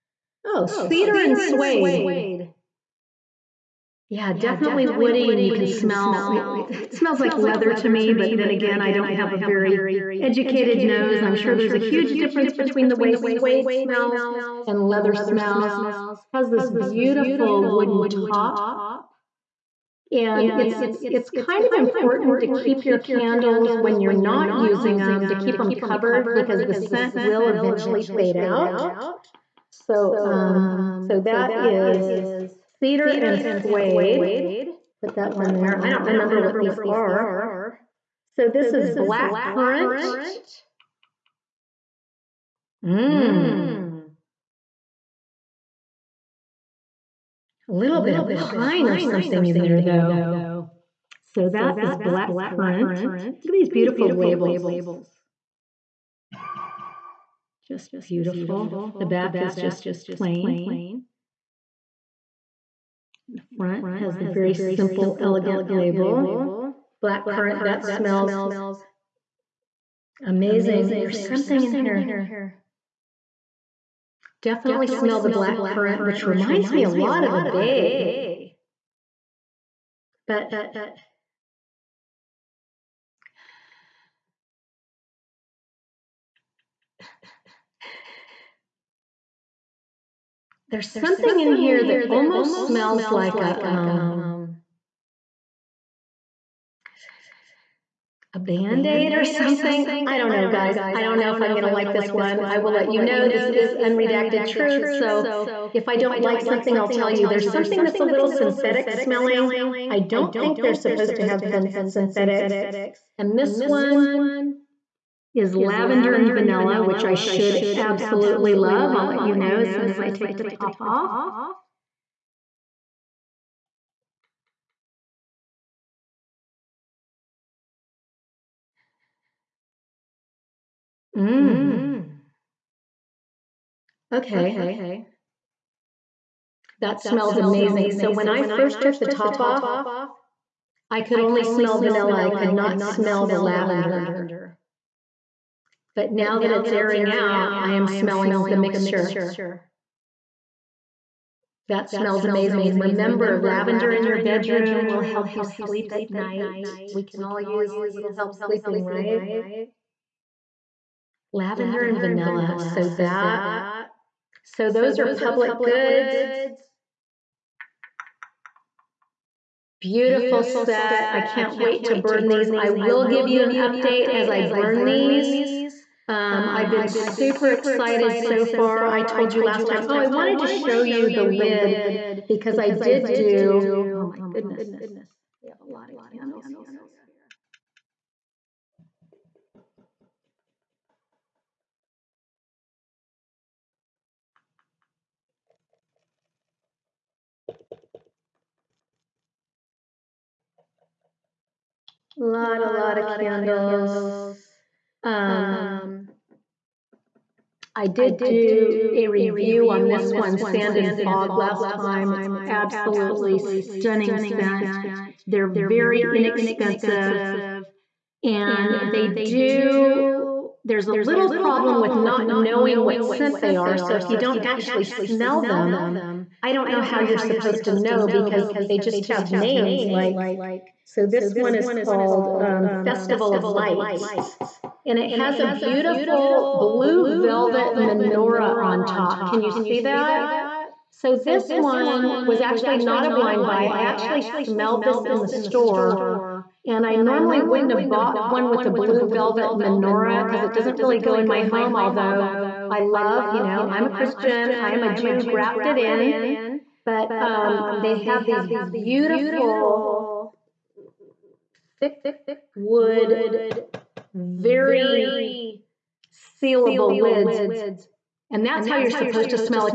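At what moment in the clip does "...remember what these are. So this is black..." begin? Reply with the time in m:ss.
0:36.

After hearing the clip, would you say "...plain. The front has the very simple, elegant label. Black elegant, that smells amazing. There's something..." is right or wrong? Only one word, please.
wrong.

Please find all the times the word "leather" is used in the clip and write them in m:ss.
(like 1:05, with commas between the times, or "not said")
0:07, 0:14.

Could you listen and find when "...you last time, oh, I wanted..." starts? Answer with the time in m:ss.
2:59.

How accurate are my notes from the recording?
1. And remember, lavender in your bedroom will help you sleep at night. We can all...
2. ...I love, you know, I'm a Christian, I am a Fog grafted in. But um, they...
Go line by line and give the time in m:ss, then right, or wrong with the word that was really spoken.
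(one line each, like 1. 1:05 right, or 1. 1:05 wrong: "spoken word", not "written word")
1. 2:32 right
2. 4:12 wrong: "Jew", not "Fog".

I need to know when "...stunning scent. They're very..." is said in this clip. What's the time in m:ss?
3:33.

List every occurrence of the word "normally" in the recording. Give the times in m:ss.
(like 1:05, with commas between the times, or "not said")
4:06.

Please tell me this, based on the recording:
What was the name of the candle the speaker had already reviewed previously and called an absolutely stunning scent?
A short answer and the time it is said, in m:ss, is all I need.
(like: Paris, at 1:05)
Sand and Fog, at 3:30.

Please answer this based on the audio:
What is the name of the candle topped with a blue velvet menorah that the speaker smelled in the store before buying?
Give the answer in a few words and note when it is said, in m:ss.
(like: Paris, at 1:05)
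Festival of Lights, at 3:52.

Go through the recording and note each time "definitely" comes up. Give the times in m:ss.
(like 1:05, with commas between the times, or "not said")
0:04, 1:14.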